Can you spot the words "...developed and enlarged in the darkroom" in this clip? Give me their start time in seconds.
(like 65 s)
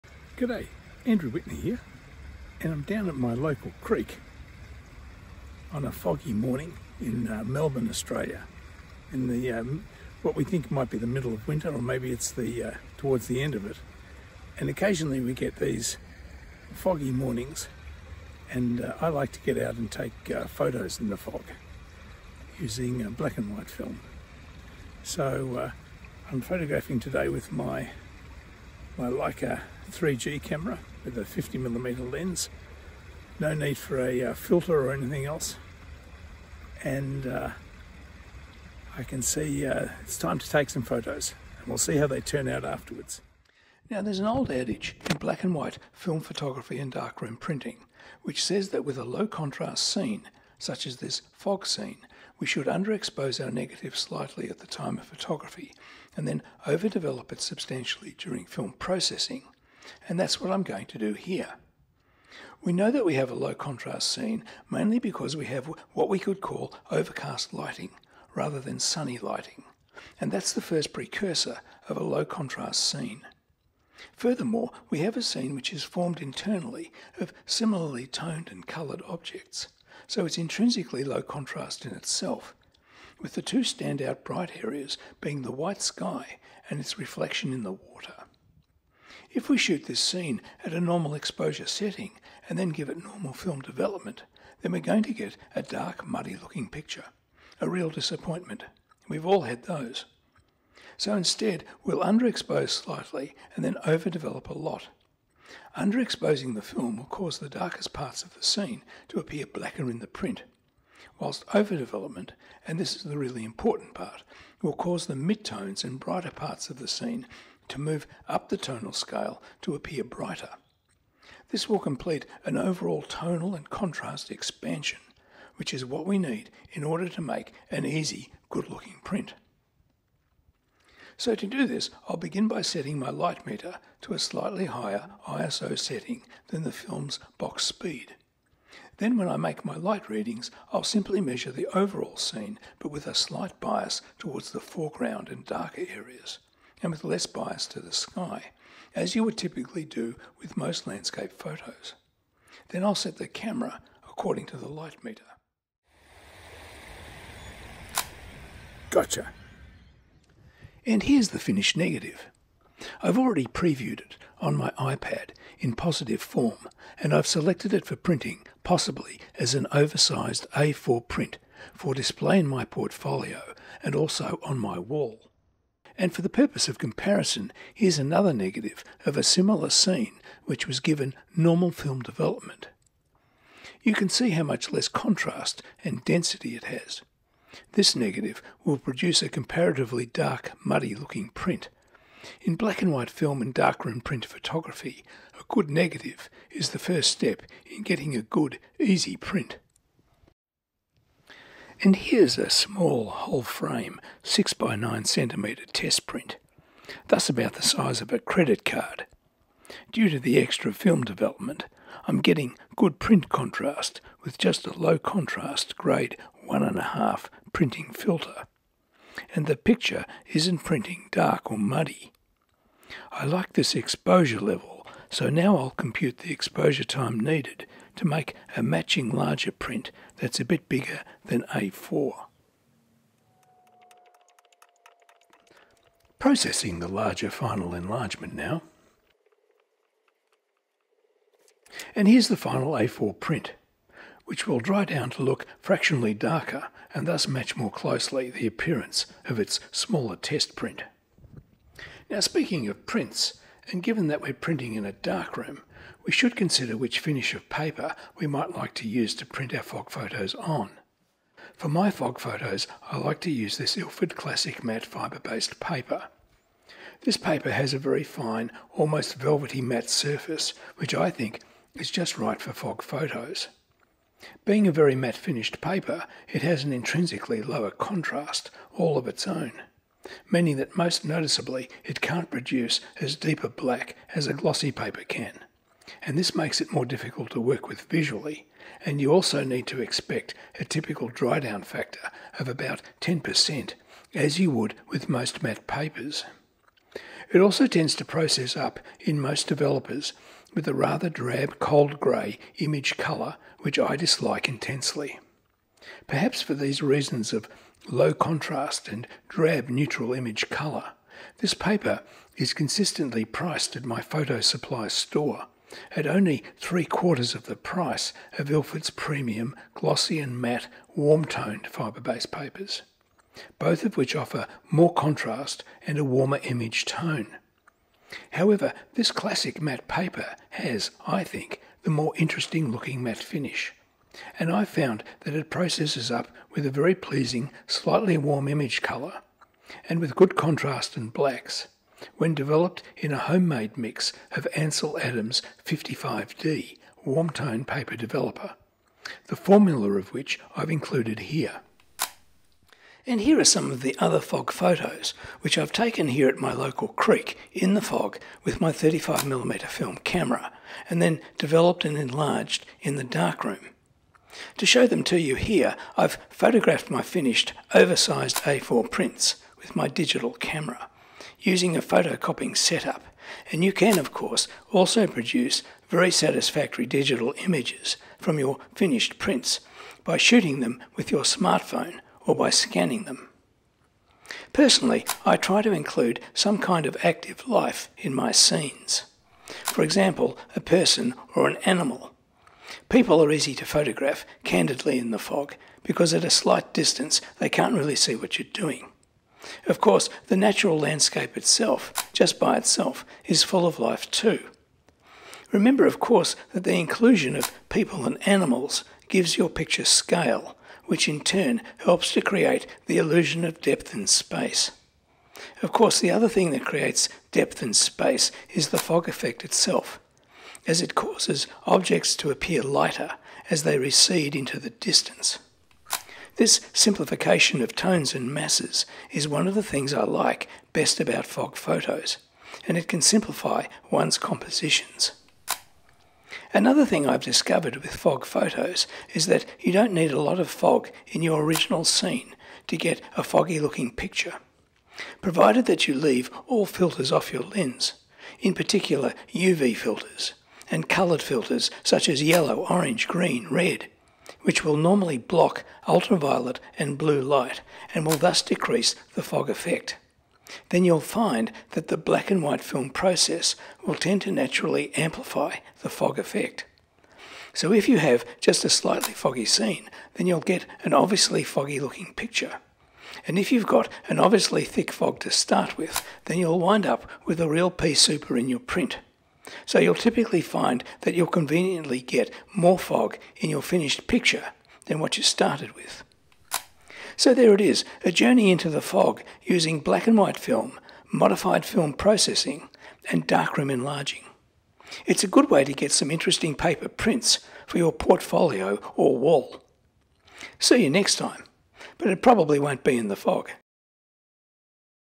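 361 s.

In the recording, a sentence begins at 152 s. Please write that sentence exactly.
Then I'll set the camera according to the light meter.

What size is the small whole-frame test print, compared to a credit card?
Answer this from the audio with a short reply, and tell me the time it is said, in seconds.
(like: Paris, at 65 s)
6 by 9 centimetres, at 204 s.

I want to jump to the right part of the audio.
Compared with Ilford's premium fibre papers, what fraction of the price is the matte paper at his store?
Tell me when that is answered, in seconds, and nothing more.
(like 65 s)
316 s.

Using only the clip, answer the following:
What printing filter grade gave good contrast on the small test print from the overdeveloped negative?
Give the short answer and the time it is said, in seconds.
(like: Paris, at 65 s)
grade 1.5, at 215 s.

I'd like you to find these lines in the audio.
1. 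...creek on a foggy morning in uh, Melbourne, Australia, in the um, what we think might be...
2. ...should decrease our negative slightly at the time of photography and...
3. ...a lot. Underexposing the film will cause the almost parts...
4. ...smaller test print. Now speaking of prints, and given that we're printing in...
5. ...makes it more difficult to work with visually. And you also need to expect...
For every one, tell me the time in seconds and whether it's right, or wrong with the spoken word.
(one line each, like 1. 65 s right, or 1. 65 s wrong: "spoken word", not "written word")
1. 3 s right
2. 52 s wrong: "underexpose", not "decrease"
3. 104 s wrong: "darkest", not "almost"
4. 249 s right
5. 286 s right.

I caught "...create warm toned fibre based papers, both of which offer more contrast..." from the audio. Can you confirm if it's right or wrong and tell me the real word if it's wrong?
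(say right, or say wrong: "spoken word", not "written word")
wrong: "matte", not "create".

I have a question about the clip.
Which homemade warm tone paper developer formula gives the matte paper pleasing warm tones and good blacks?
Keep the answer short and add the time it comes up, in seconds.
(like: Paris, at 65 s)
Ansel Adams 55D, at 344 s.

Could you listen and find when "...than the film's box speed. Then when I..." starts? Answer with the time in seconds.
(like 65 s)
136 s.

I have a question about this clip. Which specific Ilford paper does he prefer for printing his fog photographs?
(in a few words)
Ilford Classic matte fibre based.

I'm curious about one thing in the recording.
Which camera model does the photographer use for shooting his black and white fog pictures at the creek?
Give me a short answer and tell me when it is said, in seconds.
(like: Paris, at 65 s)
Leica 3G, at 29 s.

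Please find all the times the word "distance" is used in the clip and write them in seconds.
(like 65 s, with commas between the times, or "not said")
396 s, 424 s.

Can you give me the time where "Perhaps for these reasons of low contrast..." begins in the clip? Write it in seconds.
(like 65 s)
306 s.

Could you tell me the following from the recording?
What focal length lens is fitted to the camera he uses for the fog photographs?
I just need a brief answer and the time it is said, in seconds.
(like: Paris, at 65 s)
50mm, at 31 s.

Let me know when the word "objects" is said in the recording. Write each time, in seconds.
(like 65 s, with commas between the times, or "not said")
79 s, 421 s.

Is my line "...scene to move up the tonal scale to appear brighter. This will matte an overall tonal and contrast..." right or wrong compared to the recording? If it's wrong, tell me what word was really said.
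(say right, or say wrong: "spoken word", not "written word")
wrong: "complete", not "matte".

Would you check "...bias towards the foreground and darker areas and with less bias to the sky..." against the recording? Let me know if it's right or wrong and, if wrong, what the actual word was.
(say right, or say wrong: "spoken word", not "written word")
right.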